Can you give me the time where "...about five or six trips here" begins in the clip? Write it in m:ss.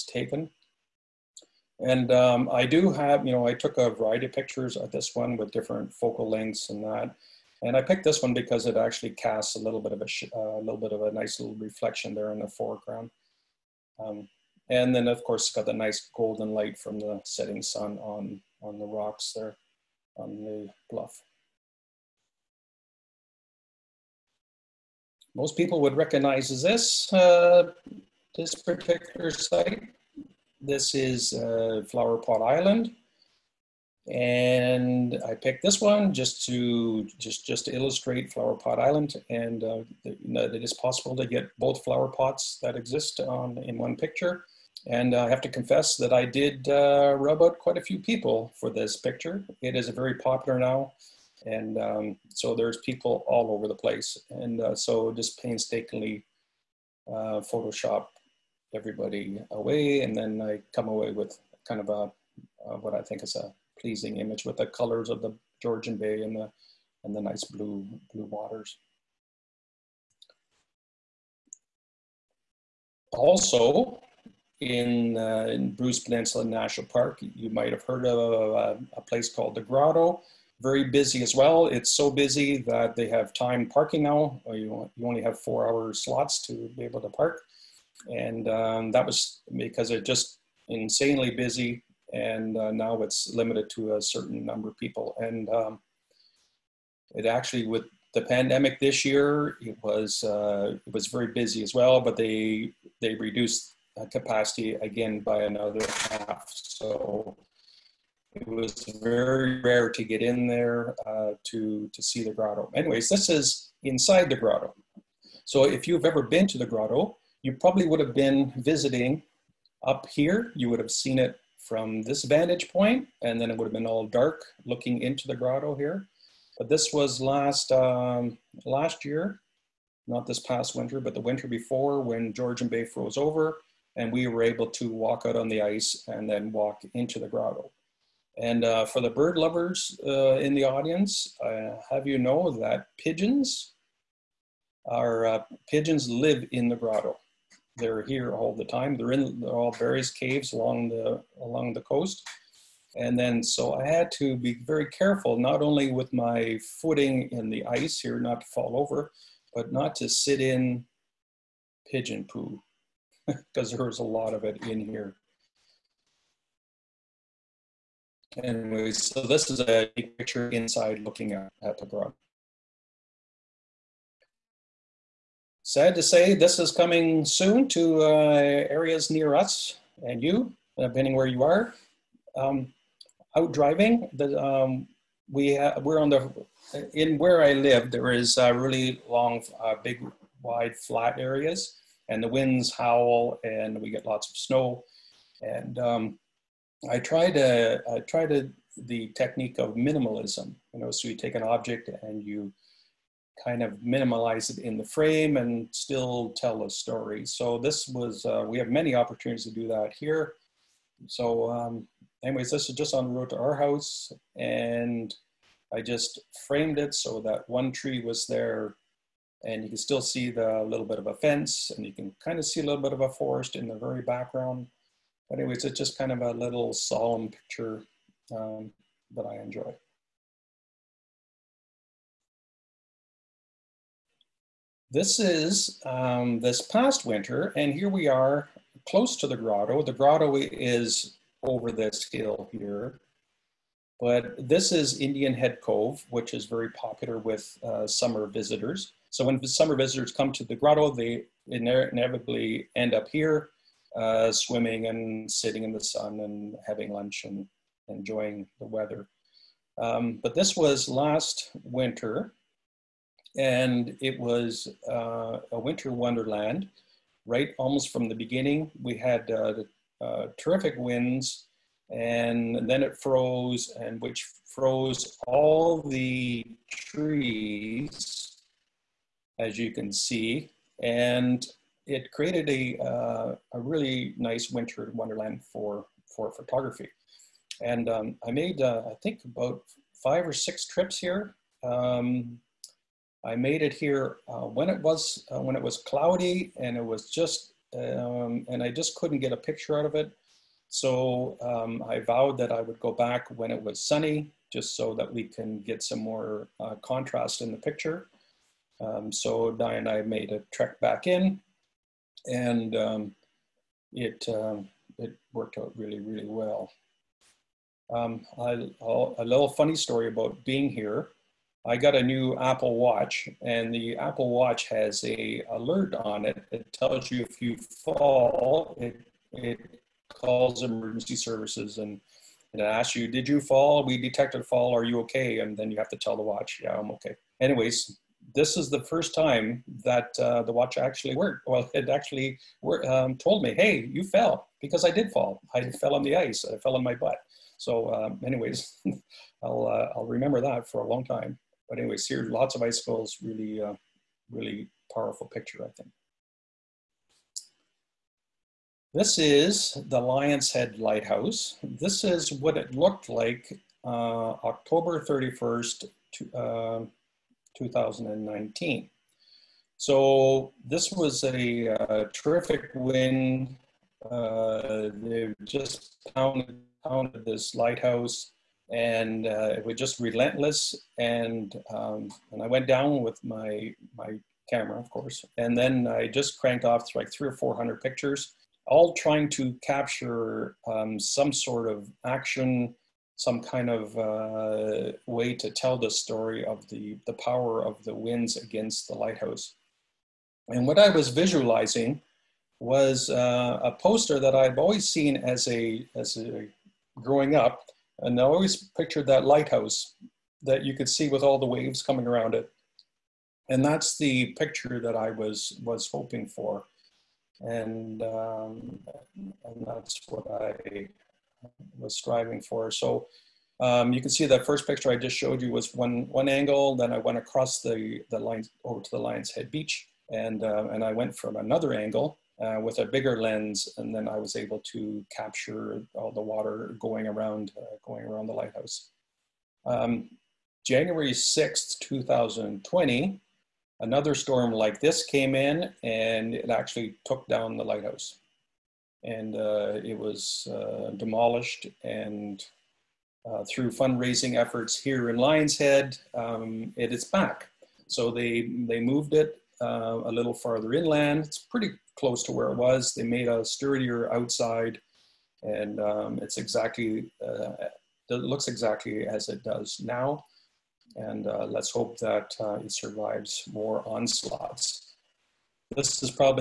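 4:49.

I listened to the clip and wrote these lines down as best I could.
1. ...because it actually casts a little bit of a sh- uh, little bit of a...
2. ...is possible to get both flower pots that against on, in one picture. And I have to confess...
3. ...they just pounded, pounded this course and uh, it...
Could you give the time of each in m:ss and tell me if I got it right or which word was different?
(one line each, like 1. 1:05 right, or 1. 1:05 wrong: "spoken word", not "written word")
1. 0:08 right
2. 0:40 wrong: "exist", not "against"
3. 6:14 wrong: "lighthouse", not "course".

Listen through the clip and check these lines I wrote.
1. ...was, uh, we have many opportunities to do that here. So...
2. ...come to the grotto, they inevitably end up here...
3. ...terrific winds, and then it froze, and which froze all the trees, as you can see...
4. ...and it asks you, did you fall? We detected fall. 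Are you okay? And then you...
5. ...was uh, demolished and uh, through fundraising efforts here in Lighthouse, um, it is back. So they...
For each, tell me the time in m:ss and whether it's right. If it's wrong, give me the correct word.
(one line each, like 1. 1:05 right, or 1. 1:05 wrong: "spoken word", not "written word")
1. 3:27 right
2. 4:10 right
3. 4:30 right
4. 5:32 right
5. 7:29 wrong: "Lionshead", not "Lighthouse".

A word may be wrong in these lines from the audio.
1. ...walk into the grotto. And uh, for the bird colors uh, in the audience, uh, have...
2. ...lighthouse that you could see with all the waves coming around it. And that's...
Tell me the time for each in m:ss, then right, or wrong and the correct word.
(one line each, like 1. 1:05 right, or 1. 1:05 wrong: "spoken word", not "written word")
1. 2:16 wrong: "lovers", not "colors"
2. 6:49 right.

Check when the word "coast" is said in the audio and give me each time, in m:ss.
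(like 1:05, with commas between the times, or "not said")
2:31.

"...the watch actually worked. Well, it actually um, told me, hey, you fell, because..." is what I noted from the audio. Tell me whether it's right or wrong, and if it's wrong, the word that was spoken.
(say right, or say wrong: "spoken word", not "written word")
right.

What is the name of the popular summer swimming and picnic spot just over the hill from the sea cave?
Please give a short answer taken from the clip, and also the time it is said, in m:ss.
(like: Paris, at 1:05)
Indian Head Cove, at 4:04.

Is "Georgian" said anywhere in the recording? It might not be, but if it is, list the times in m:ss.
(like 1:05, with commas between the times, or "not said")
1:05, 2:12.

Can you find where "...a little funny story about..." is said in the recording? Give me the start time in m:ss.
5:18.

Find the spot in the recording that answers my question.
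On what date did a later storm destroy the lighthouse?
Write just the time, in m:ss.
7:20.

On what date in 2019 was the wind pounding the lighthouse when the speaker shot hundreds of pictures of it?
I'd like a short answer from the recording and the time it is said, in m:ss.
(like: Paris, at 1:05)
October 31, at 6:04.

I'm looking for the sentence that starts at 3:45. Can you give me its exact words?
But anyways, it's just kind of a little solemn picture um, that I enjoy.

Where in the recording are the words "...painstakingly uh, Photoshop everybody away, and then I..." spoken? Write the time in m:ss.
0:55.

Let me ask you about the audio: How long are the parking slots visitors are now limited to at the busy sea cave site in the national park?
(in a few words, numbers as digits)
4 hours.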